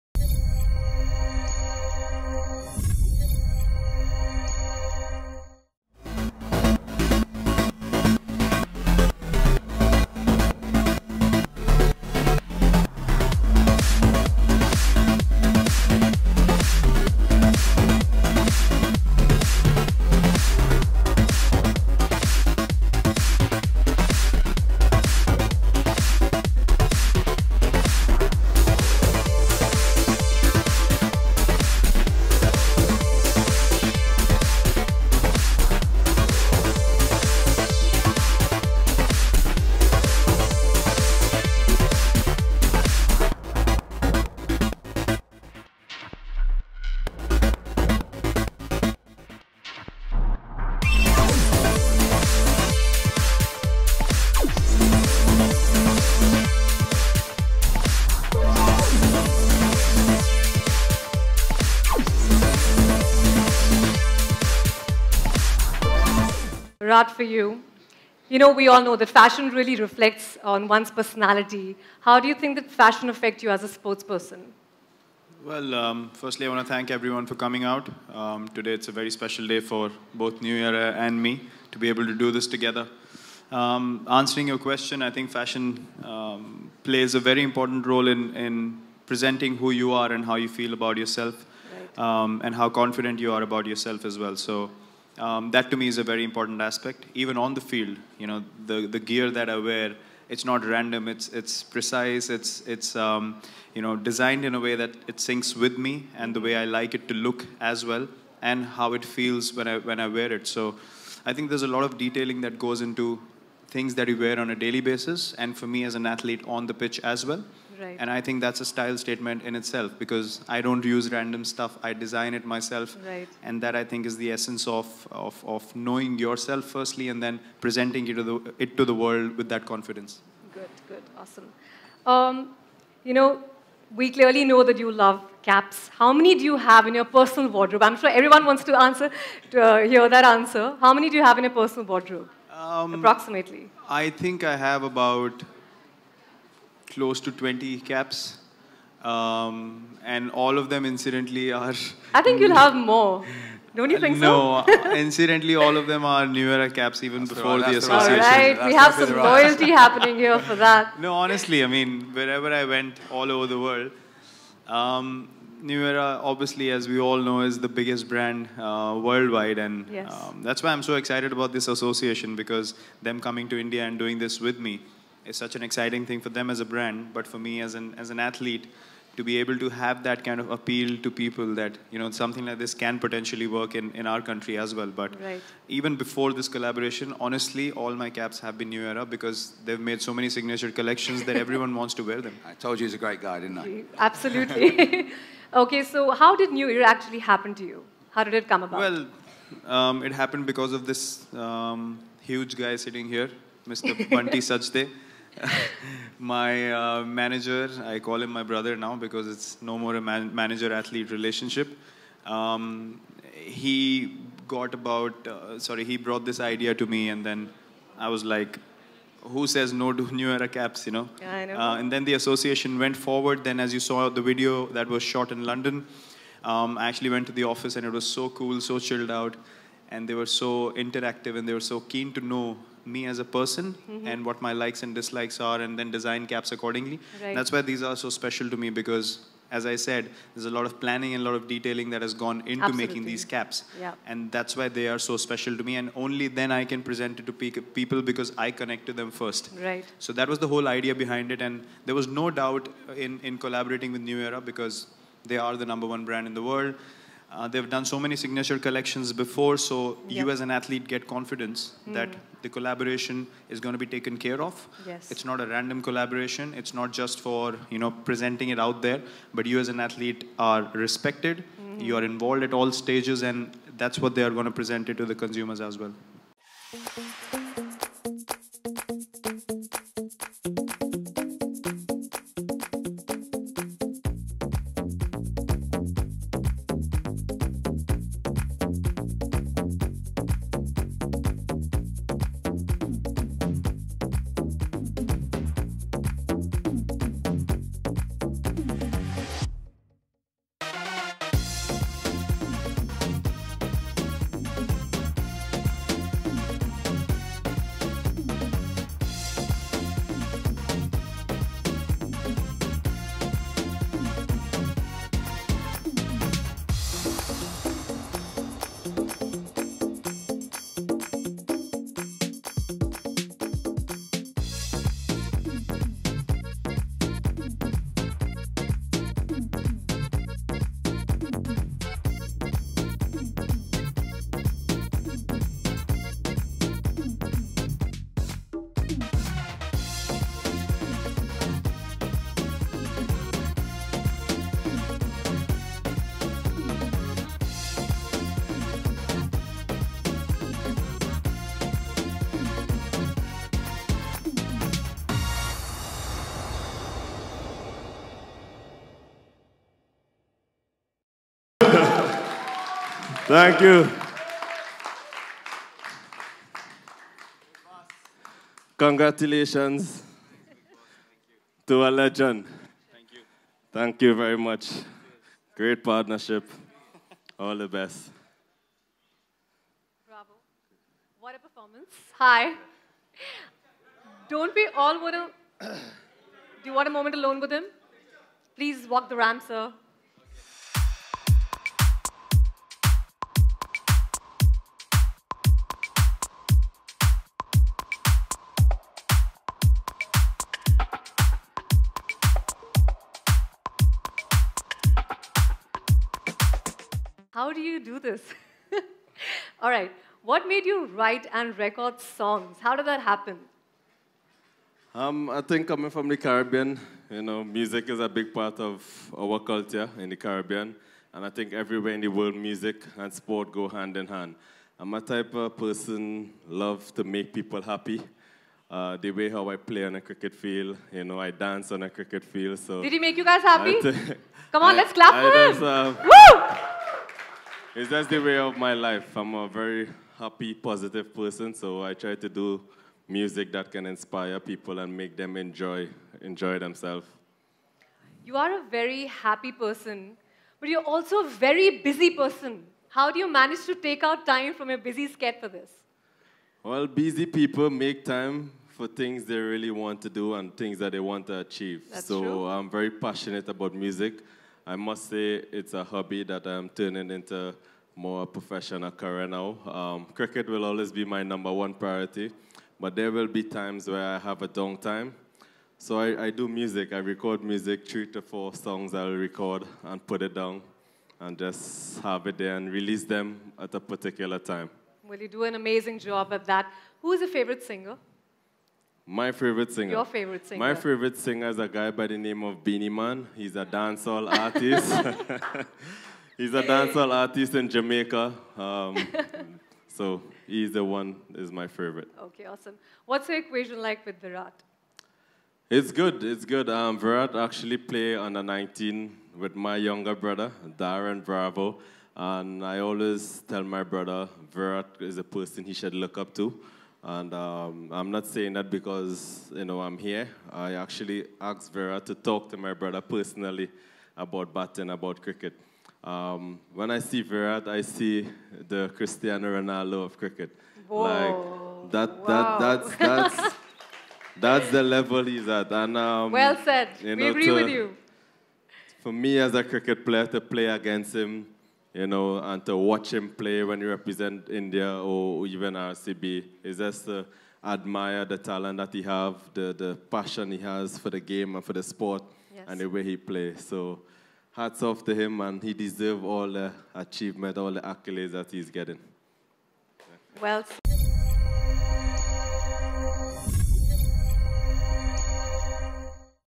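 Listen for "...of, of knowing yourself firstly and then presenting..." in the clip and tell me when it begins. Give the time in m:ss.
2:05.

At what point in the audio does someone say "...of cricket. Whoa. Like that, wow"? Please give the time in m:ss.
8:50.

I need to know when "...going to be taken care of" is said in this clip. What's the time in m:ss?
4:23.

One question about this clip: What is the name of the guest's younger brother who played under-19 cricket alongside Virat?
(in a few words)
Darren Bravo.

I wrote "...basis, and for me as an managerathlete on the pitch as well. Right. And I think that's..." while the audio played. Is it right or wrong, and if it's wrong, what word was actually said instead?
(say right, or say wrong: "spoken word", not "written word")
wrong: "athlete", not "managerathlete".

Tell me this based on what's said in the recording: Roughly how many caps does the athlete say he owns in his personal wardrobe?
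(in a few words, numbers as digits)
20.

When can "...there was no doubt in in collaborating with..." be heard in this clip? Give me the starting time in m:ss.
4:11.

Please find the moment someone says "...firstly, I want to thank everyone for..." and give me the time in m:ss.
1:16.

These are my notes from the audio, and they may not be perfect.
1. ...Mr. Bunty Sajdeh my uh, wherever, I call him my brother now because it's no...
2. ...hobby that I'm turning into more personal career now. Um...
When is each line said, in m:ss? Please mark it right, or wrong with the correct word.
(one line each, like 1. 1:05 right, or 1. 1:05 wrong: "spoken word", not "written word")
1. 3:23 wrong: "manager", not "wherever"
2. 7:45 wrong: "professional", not "personal".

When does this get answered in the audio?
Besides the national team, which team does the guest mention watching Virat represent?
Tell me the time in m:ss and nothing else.
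9:05.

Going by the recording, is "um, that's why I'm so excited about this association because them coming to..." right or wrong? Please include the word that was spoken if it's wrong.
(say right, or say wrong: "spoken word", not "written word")
right.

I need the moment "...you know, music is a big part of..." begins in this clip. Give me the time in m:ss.
6:57.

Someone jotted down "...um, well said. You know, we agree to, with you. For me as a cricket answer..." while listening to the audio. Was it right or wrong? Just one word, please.
wrong.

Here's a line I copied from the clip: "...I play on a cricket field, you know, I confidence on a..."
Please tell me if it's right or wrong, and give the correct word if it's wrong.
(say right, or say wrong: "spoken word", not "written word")
wrong: "dance", not "confidence".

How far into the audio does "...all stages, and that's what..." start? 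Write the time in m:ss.
4:32.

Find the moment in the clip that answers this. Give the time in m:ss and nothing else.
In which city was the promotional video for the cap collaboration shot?
3:45.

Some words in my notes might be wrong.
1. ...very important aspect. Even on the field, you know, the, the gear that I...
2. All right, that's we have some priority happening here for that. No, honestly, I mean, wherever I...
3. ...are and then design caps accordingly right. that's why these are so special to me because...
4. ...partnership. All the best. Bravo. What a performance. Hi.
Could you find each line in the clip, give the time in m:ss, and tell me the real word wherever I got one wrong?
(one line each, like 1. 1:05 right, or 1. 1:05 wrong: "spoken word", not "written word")
1. 1:36 right
2. 2:38 wrong: "loyalty", not "priority"
3. 3:55 right
4. 6:15 right.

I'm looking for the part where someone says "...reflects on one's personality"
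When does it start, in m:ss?
1:09.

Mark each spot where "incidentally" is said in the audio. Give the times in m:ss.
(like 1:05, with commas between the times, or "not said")
2:30, 2:34.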